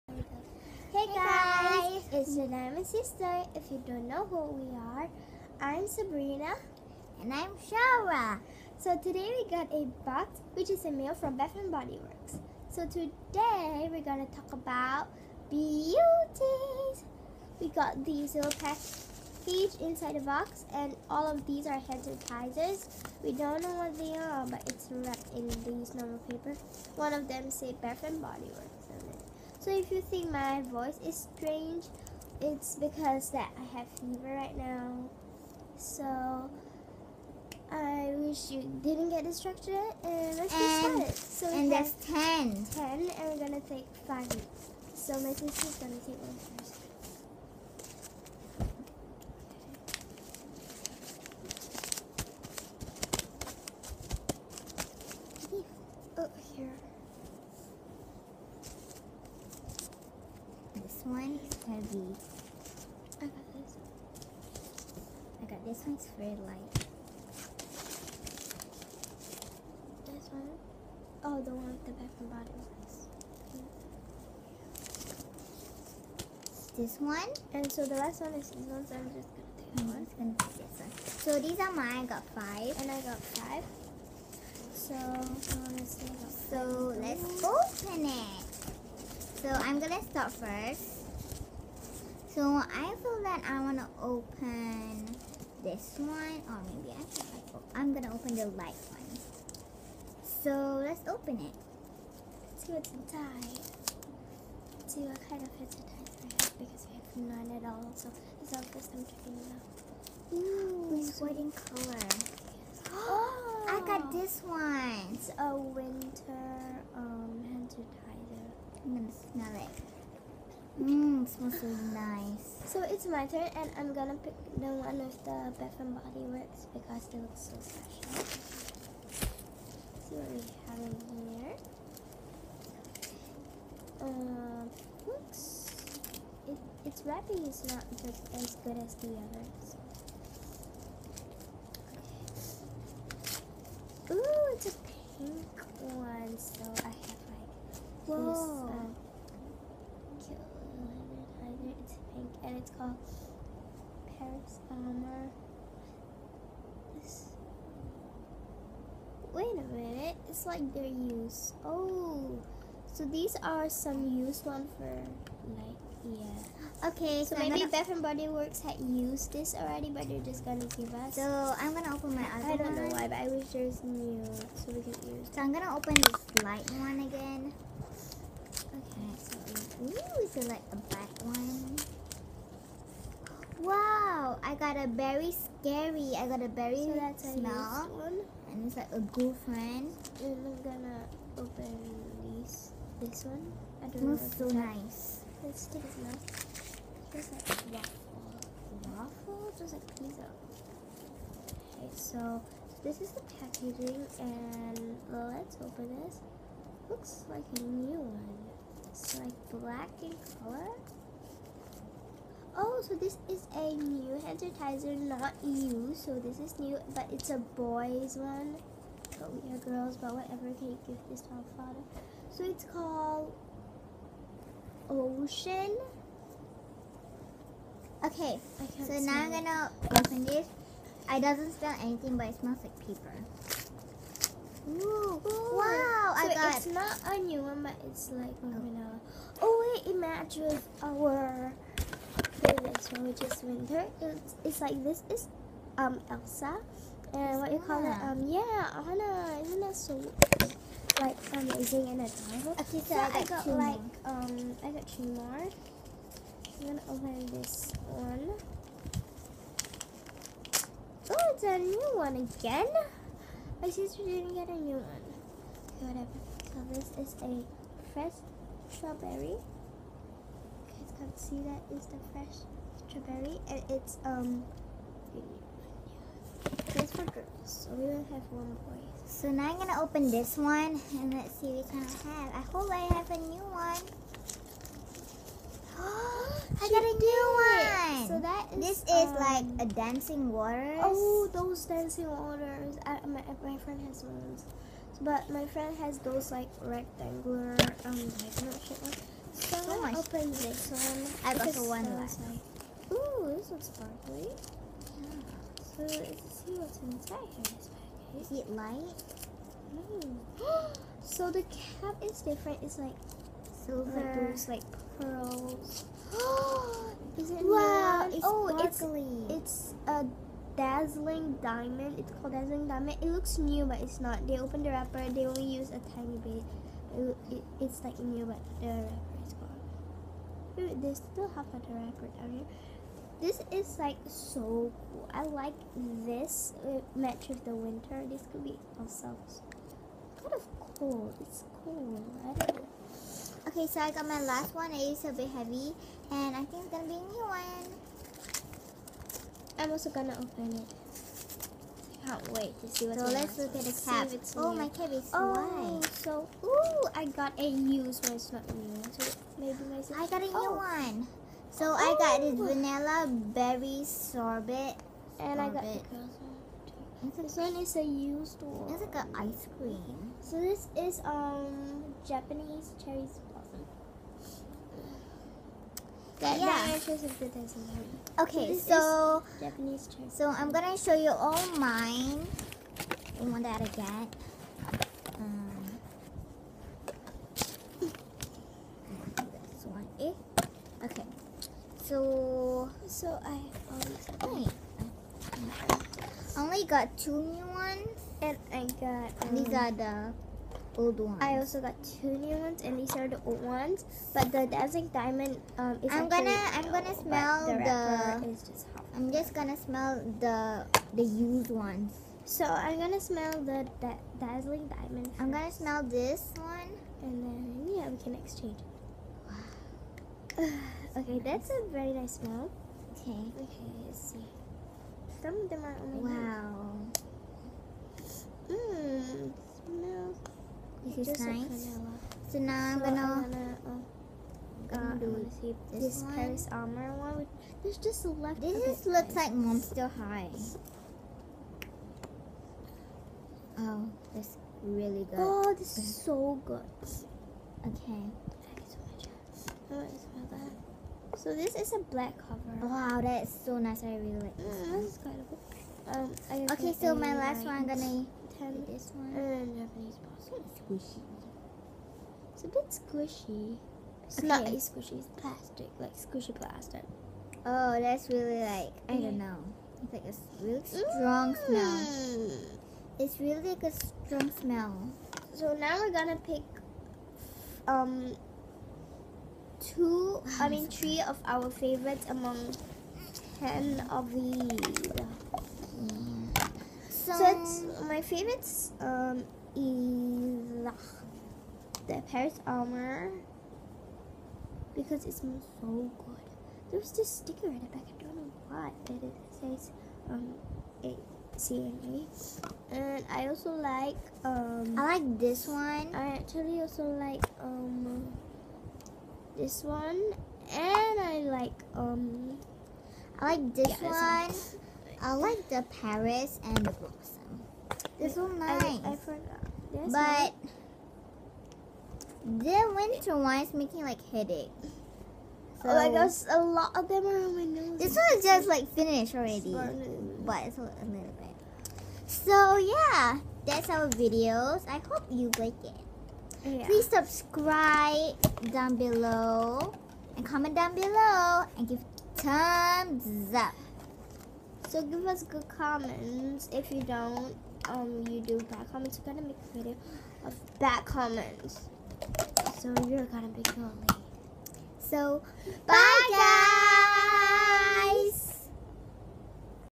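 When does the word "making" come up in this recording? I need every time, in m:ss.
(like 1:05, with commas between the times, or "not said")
8:43.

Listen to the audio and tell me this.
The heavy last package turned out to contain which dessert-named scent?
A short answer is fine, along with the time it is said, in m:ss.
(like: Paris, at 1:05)
Vanilla berry sorbet, at 6:02.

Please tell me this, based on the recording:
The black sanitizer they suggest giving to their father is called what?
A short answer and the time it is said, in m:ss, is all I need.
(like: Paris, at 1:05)
Ocean, at 3:44.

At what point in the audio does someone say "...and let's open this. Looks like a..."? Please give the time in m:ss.
3:24.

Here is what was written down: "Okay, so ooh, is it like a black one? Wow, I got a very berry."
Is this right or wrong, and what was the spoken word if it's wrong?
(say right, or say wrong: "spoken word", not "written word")
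wrong: "scary", not "berry".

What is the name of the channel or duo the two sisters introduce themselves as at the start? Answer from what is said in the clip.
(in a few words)
Diamond Sister.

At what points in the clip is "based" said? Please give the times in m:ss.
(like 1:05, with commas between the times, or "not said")
not said.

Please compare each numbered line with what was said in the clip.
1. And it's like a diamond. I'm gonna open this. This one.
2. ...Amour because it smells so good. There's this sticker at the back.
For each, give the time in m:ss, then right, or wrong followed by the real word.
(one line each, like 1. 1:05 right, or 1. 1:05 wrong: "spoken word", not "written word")
1. 3:08 wrong: "girlfriend", not "diamond"
2. 8:12 right.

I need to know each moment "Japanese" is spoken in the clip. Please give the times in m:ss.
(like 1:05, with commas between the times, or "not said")
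6:12, 6:19, 7:39.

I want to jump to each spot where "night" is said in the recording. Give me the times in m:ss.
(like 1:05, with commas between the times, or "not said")
5:02.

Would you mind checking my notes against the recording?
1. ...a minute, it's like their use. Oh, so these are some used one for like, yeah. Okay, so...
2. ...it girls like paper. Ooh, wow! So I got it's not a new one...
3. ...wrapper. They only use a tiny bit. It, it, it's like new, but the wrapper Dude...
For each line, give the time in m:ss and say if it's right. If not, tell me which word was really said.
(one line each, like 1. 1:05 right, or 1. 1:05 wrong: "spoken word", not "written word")
1. 2:39 right
2. 3:52 wrong: "smells", not "girls"
3. 5:24 right.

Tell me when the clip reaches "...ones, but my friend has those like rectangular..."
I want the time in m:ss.
4:54.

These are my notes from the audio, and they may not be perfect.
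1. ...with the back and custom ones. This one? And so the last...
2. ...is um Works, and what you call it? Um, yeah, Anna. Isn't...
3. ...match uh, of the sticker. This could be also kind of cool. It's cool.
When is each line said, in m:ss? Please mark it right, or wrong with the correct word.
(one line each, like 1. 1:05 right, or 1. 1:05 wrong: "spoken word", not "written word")
1. 1:11 wrong: "bottom", not "custom"
2. 4:05 wrong: "Elsa", not "Works"
3. 5:36 wrong: "winter", not "sticker".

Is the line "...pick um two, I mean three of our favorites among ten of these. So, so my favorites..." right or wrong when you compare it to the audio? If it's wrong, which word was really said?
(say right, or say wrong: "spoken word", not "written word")
right.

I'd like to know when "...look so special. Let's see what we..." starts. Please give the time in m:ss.
2:07.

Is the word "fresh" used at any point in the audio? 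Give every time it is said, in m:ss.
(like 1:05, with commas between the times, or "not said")
4:27, 4:32.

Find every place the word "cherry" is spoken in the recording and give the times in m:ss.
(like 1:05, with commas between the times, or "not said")
6:12, 6:19.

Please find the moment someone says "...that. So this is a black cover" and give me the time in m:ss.
7:30.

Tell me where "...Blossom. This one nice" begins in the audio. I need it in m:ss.
8:36.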